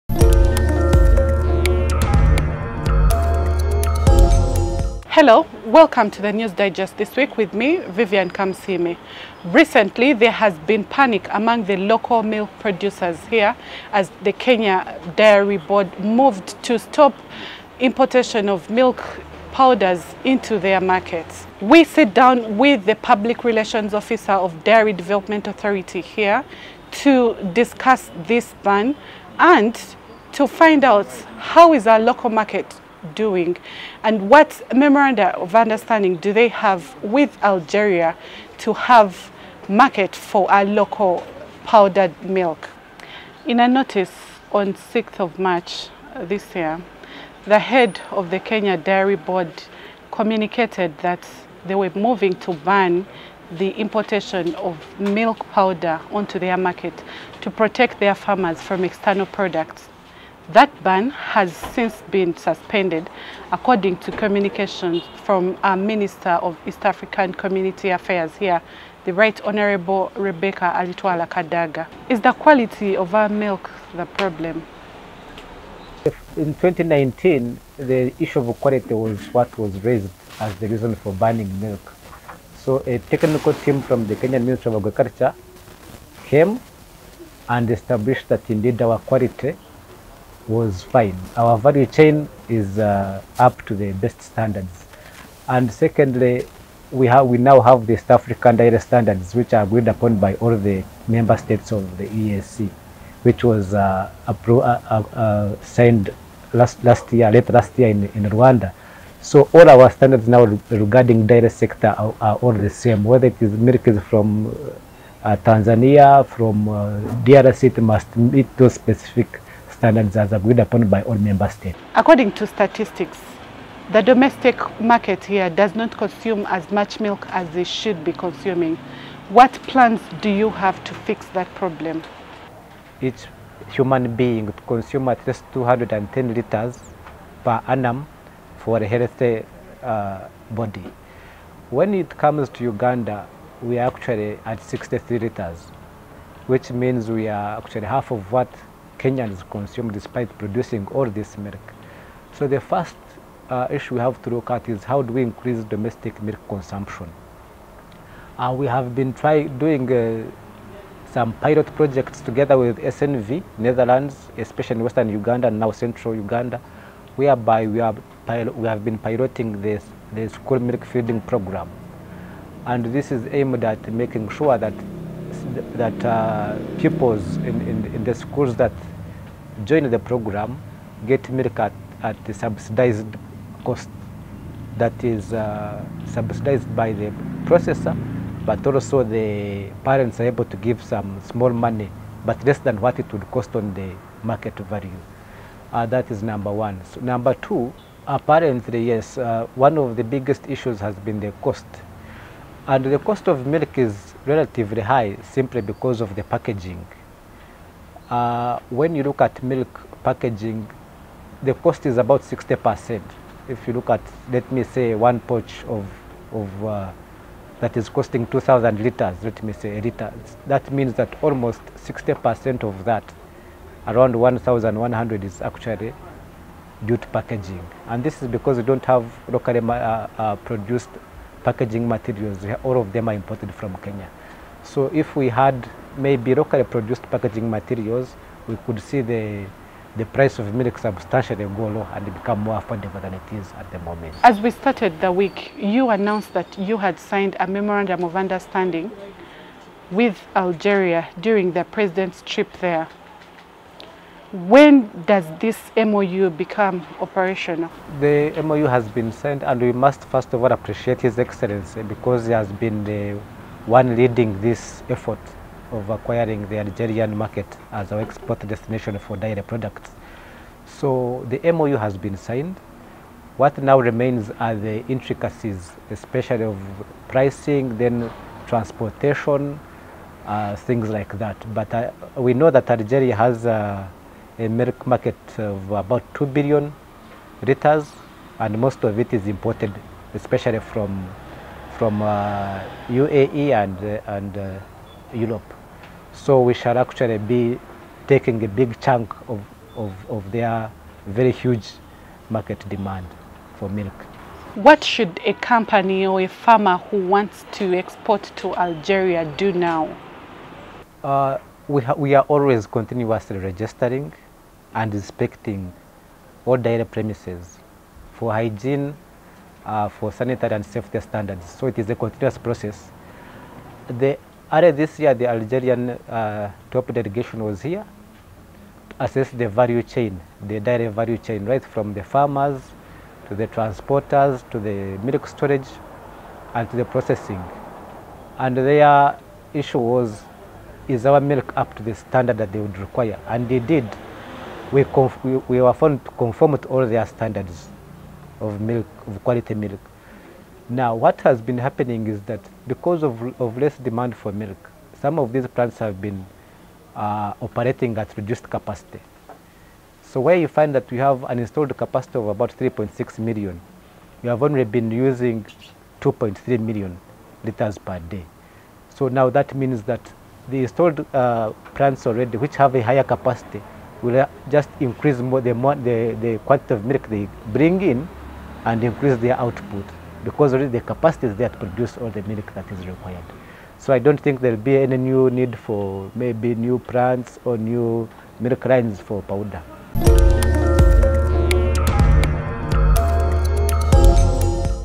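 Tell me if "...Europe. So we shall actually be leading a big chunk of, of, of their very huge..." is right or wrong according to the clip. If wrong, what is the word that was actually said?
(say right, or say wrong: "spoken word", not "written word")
wrong: "taking", not "leading".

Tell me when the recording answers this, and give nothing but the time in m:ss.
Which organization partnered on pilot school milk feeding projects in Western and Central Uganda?
2:42.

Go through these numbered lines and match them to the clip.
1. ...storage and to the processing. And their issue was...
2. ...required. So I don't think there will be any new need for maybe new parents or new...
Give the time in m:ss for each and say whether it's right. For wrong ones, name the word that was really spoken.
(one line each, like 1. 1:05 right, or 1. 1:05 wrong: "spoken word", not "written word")
1. 5:35 right
2. 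6:22 wrong: "plants", not "parents".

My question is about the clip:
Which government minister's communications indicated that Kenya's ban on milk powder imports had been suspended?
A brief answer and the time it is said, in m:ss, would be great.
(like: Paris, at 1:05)
Rebecca Alitwala Kadaga, at 1:10.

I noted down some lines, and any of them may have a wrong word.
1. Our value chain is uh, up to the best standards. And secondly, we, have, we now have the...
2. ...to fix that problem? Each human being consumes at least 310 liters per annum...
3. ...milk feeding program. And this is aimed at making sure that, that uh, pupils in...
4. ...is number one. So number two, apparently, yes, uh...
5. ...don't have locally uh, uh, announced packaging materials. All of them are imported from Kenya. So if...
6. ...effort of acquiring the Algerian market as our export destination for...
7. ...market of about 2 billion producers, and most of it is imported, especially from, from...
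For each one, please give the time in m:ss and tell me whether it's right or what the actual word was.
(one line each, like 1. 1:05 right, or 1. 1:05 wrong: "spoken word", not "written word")
1. 1:31 right
2. 2:10 wrong: "210", not "310"
3. 2:50 right
4. 3:16 right
5. 3:48 wrong: "produced", not "announced"
6. 4:24 right
7. 4:44 wrong: "liters", not "producers".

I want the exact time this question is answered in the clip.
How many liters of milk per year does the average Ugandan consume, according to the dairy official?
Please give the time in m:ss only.
2:24.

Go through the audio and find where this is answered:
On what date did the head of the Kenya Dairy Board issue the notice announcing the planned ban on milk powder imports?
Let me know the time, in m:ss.
0:44.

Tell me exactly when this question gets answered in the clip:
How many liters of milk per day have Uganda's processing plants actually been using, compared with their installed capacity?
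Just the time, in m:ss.
6:05.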